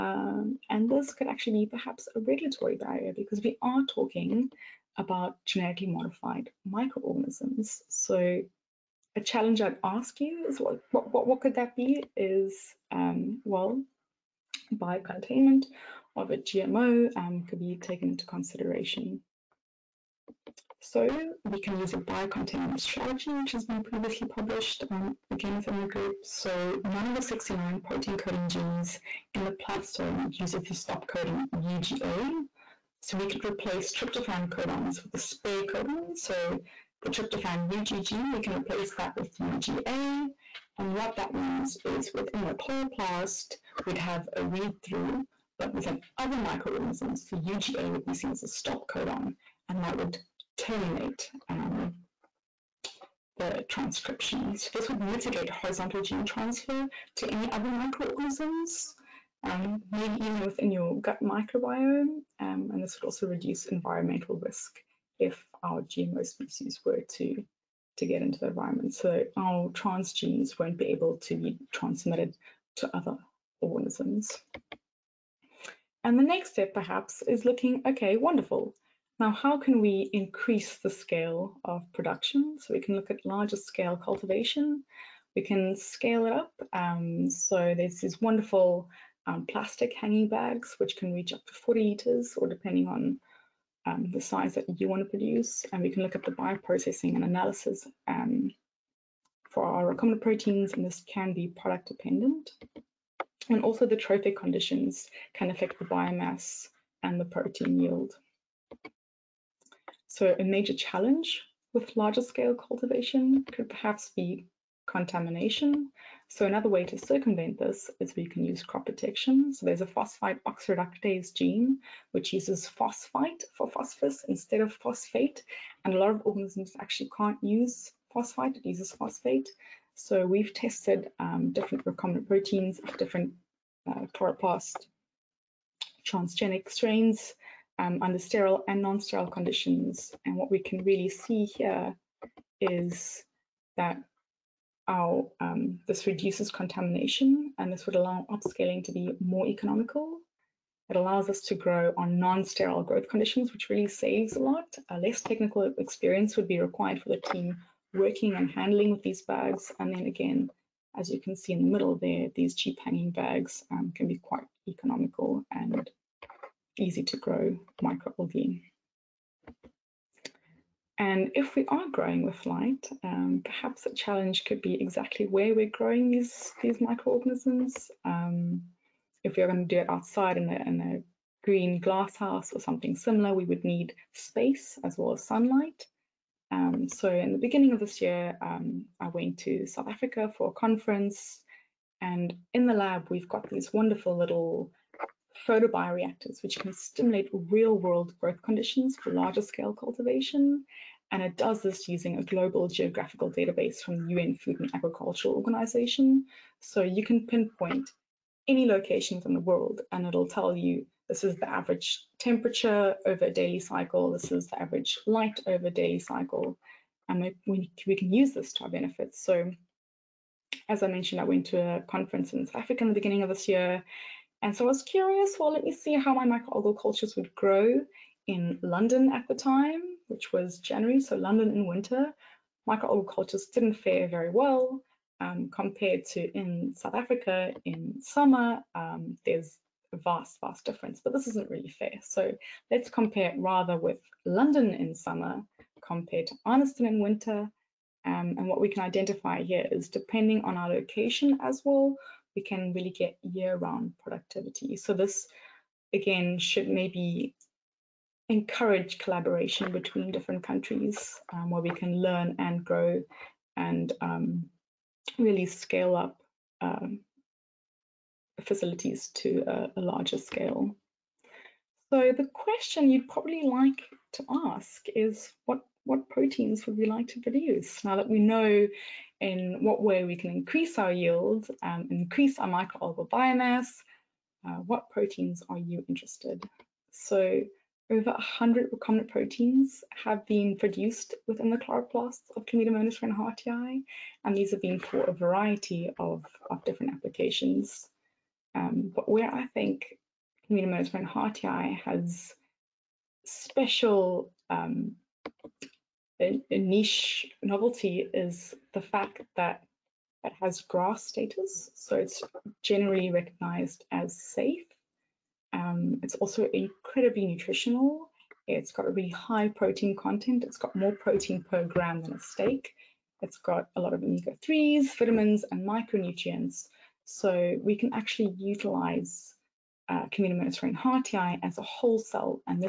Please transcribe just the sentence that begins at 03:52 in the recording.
Microalgal cultures didn't fare very well um, compared to in South Africa in summer.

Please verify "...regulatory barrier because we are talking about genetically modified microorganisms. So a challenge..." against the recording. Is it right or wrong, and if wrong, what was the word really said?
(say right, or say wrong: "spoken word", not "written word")
right.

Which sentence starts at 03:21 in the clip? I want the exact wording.
And it does this using a global geographical database from the UN Food and Agricultural Organization.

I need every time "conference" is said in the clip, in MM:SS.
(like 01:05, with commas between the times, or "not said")
03:10, 03:41.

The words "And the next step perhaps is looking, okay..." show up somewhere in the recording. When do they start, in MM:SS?
01:16.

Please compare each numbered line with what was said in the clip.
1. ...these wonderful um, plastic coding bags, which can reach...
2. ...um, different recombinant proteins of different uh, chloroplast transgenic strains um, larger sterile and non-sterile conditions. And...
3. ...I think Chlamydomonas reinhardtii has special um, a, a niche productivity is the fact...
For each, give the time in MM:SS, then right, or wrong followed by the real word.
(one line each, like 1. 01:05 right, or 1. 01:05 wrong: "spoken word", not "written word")
1. 01:28 wrong: "hanging", not "coding"
2. 02:11 wrong: "under", not "larger"
3. 04:59 wrong: "novelty", not "productivity".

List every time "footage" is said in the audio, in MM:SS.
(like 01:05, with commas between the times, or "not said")
not said.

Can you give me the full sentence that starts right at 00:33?
So we could replace tryptophan codons with the spare codon.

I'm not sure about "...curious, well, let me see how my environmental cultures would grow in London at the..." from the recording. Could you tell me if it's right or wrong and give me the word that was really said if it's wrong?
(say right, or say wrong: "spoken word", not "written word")
wrong: "microalgal", not "environmental".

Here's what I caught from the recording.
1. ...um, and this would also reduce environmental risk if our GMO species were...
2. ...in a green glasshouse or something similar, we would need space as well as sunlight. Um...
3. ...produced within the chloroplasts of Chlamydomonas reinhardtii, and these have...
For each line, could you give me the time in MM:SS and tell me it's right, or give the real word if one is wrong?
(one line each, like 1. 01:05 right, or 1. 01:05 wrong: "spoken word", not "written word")
1. 01:02 right
2. 03:00 right
3. 04:50 right.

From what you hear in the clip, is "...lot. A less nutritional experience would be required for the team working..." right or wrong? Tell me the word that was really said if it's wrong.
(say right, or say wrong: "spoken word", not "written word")
wrong: "technical", not "nutritional".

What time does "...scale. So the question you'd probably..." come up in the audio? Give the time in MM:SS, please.
04:30.